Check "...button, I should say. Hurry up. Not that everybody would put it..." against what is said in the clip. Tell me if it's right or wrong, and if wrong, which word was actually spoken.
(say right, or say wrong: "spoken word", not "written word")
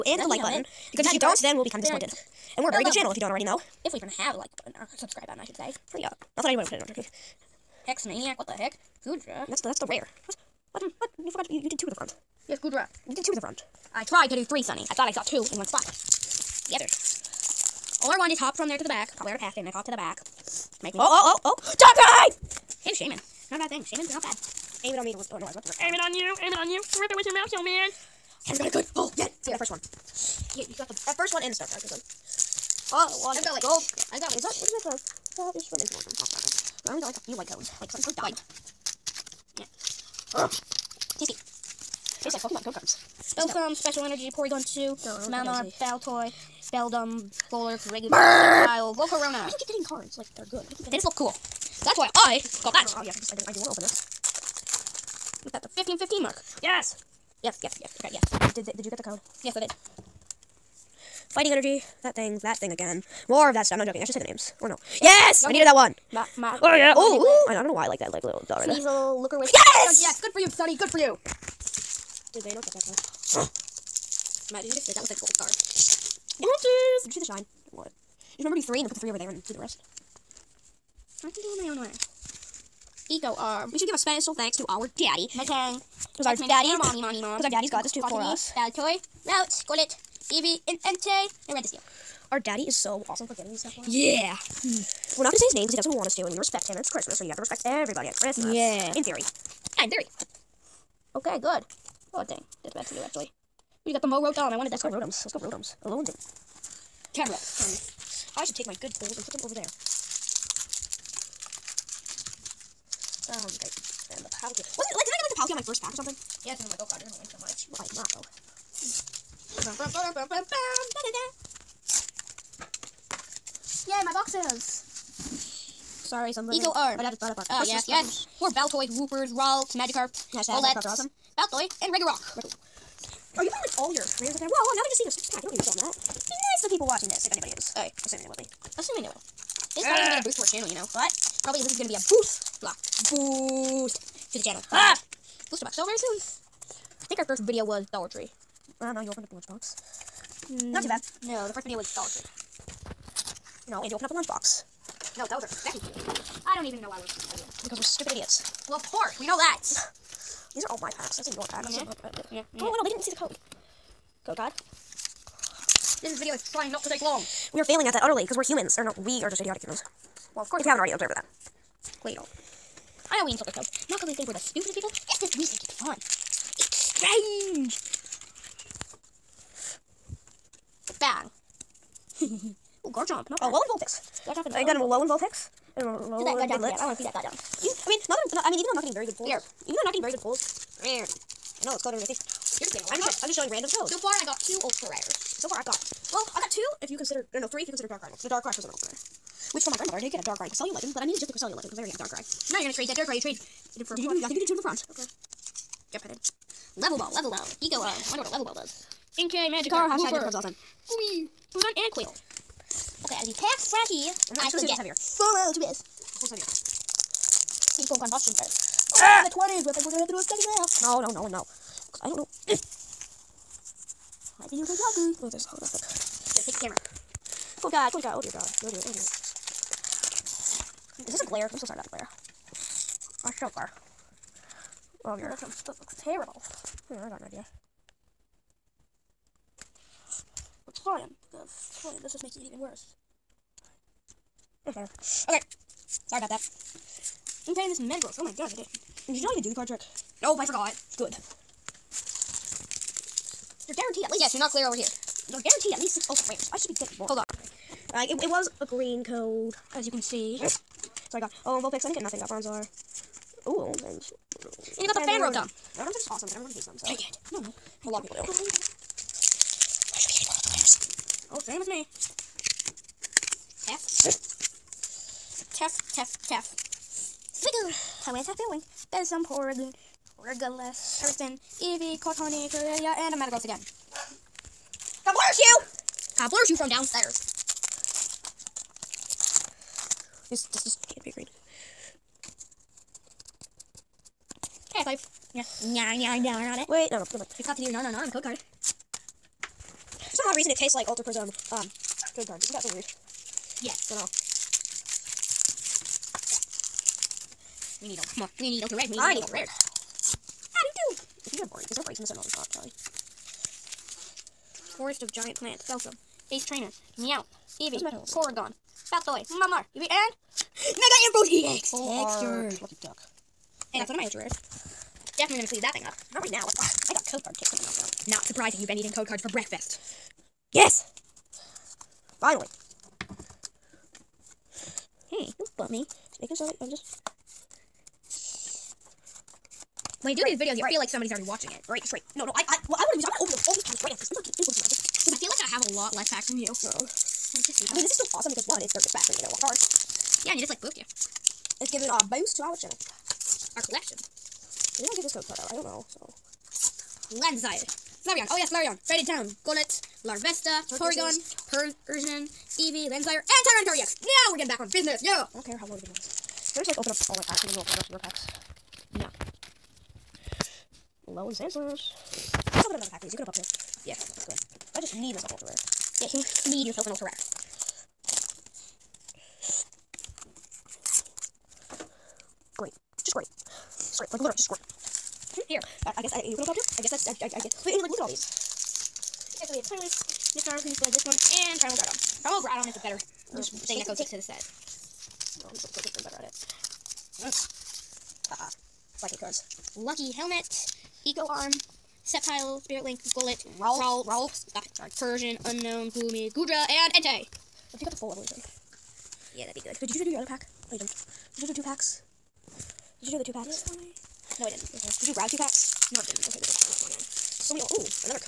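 wrong: "anybody", not "everybody".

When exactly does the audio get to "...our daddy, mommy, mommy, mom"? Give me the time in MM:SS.
01:26.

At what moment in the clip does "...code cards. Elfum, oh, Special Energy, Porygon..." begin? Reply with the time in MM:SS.
00:42.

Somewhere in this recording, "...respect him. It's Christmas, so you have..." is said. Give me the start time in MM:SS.
01:36.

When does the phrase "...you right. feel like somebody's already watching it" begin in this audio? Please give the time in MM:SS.
05:40.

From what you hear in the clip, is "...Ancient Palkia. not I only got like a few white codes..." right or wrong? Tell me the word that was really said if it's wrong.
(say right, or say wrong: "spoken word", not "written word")
wrong: "Origin", not "Palkia".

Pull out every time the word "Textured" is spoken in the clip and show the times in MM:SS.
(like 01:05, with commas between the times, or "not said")
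05:21.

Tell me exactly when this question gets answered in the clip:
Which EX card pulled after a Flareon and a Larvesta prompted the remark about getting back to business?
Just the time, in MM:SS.
06:03.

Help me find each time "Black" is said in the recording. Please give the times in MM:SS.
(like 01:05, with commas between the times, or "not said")
06:39.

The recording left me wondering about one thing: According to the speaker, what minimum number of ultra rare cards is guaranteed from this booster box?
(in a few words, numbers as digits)
6.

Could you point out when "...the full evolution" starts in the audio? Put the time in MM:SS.
06:47.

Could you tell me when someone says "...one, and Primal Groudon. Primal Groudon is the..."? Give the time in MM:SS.
06:31.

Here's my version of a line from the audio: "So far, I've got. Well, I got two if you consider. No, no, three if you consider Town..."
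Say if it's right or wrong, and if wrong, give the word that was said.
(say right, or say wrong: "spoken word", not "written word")
wrong: "Dark", not "Town".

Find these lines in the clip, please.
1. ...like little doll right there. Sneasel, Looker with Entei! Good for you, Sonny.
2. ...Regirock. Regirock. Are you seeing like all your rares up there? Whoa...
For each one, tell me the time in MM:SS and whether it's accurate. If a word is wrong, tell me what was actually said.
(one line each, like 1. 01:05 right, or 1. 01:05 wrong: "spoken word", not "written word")
1. 01:08 wrong: "Yes", not "Entei"
2. 02:11 wrong: "putting", not "seeing".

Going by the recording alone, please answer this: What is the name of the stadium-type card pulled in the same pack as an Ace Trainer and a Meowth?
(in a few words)
Forest of Giant Plants.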